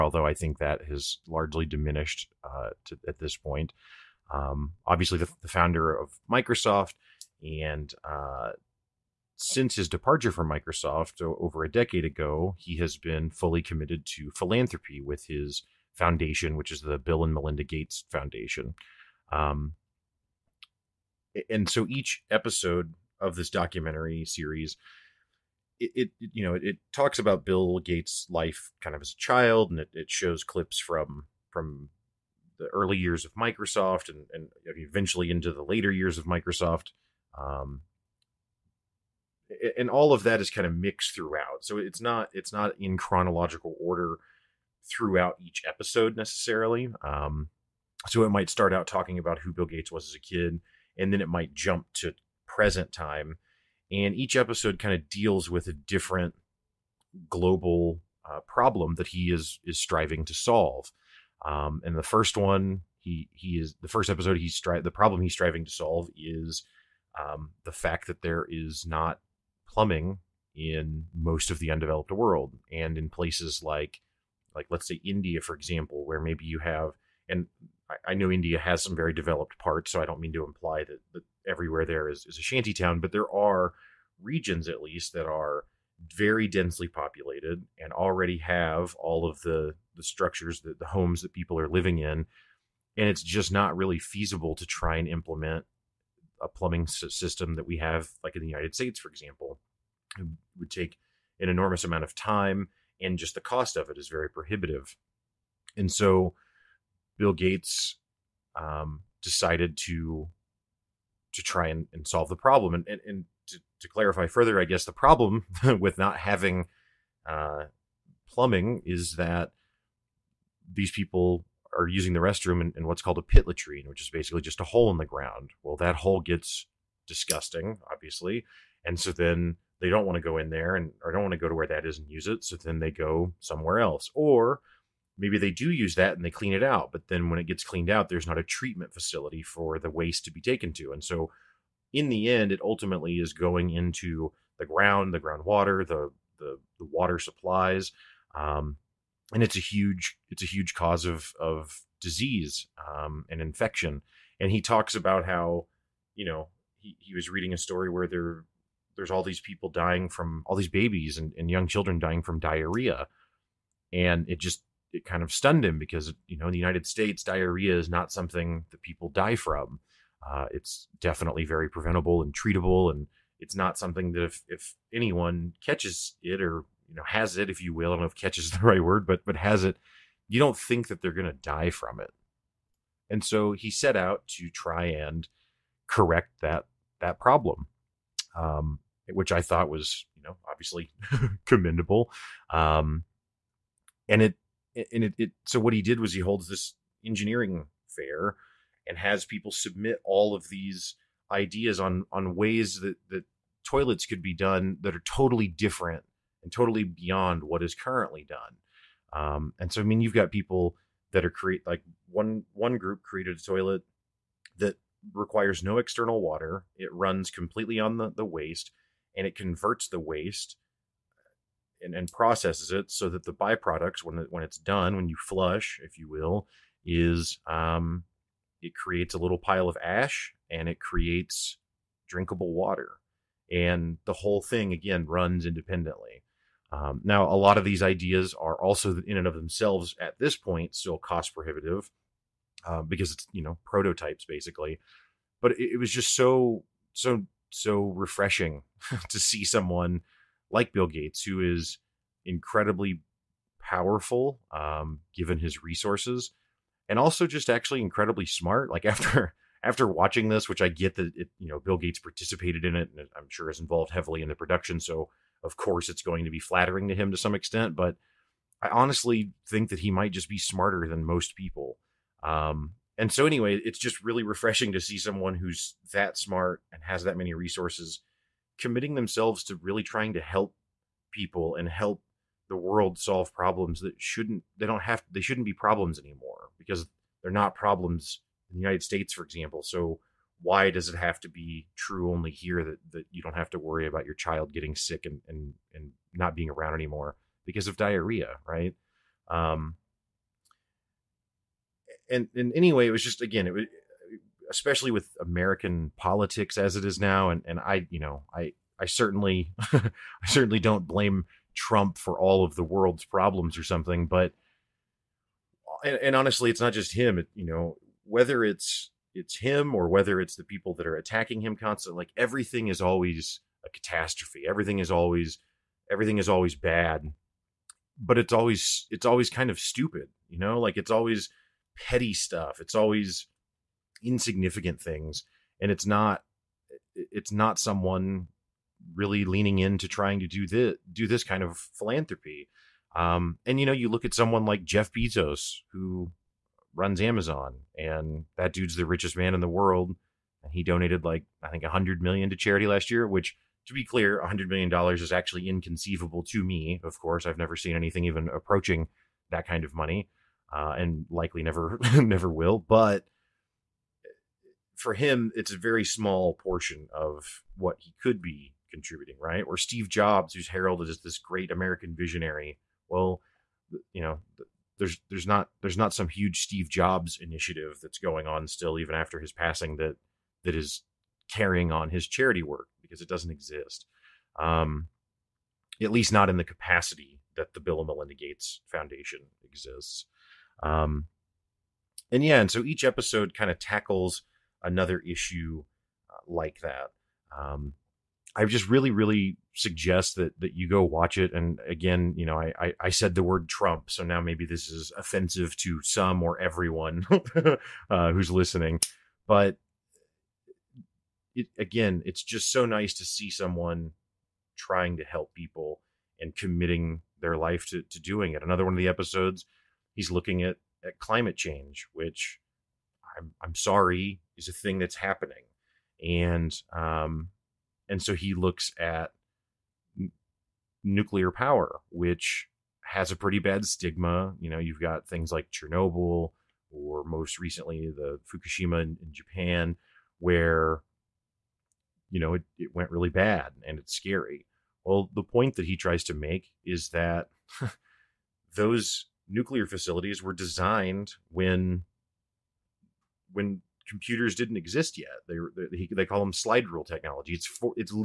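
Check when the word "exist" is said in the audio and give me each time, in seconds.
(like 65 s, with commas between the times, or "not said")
383 s, 389 s, 454 s.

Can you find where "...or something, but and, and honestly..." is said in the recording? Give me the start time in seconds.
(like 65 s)
313 s.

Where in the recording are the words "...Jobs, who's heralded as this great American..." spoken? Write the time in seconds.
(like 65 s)
369 s.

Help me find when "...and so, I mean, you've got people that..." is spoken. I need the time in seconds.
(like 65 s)
209 s.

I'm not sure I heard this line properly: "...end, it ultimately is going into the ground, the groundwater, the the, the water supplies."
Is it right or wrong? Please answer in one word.
right.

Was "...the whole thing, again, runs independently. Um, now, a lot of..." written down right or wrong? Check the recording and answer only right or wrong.
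right.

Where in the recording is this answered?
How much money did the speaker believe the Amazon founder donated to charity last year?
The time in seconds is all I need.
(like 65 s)
351 s.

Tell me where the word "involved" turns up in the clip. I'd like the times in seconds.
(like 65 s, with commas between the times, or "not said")
263 s.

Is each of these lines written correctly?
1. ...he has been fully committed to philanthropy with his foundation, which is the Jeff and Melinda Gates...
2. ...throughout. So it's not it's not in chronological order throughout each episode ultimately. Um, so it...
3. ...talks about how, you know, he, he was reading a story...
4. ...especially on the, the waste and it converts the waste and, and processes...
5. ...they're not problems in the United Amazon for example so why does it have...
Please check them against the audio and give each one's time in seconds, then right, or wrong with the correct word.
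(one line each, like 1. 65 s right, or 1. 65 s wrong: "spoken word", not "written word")
1. 12 s wrong: "Bill", not "Jeff"
2. 41 s wrong: "necessarily", not "ultimately"
3. 154 s right
4. 217 s wrong: "completely", not "especially"
5. 287 s wrong: "States", not "Amazon".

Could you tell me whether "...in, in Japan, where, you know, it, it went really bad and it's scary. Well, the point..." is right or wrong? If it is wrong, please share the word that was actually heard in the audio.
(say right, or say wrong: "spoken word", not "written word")
right.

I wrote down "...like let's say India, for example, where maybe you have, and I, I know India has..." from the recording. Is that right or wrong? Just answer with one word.
right.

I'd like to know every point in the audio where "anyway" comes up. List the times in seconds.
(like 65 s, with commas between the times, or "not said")
273 s, 302 s.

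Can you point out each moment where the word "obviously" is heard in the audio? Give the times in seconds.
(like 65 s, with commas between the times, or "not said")
4 s, 127 s, 190 s.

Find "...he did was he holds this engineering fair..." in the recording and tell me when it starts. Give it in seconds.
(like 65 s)
195 s.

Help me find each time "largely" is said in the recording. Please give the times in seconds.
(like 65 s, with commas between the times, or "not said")
1 s.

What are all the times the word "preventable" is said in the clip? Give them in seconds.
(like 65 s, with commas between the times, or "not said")
171 s.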